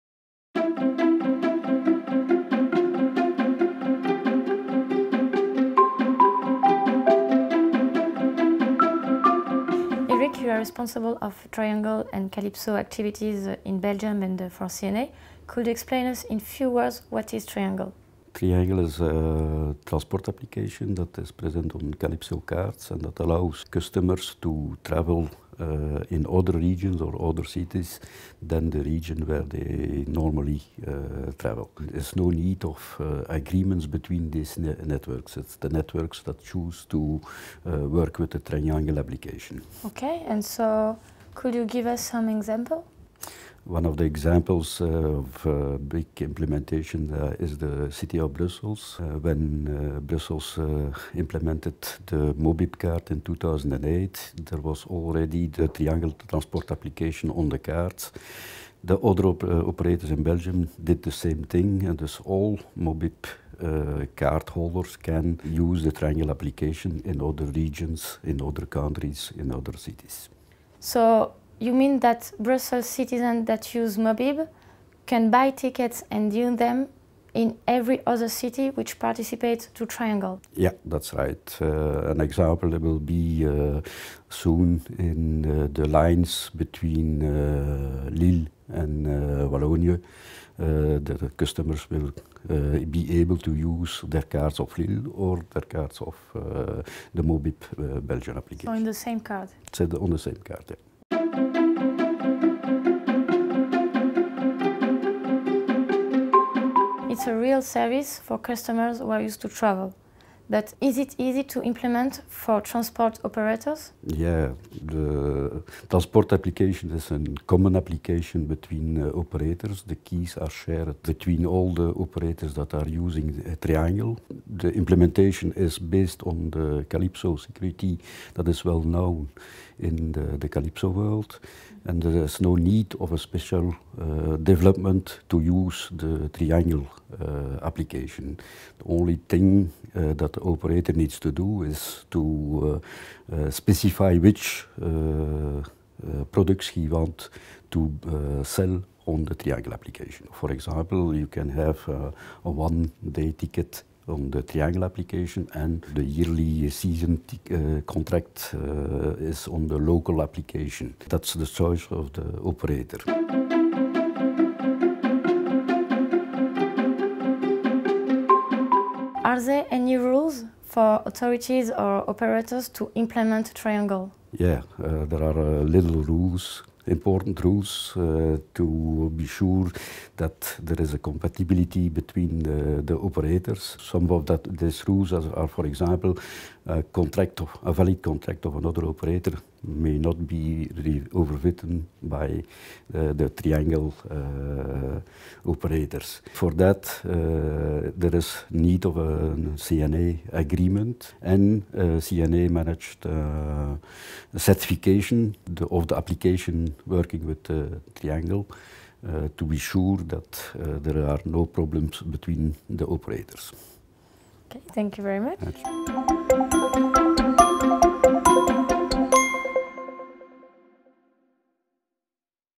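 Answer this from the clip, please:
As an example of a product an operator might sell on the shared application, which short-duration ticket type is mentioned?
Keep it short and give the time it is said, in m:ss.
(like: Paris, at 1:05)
One-day ticket, at 2:32.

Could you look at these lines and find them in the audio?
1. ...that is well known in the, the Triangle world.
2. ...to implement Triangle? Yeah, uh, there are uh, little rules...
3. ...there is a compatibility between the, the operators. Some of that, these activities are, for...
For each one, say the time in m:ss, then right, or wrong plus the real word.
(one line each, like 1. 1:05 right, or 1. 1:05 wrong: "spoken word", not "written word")
1. 2:08 wrong: "Calypso", not "Triangle"
2. 2:52 right
3. 3:00 wrong: "rules", not "activities".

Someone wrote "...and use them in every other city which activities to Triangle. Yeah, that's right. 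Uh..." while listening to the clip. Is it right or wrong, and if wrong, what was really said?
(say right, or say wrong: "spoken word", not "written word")
wrong: "participates", not "activities".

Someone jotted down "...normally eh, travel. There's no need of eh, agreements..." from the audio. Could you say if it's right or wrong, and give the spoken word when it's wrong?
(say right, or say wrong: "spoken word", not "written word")
right.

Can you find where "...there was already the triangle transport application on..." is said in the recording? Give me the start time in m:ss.
0:54.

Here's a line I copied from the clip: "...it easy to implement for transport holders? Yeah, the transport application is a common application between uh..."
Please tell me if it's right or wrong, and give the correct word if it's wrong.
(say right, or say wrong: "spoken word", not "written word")
wrong: "operators", not "holders".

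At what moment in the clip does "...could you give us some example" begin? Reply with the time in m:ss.
0:41.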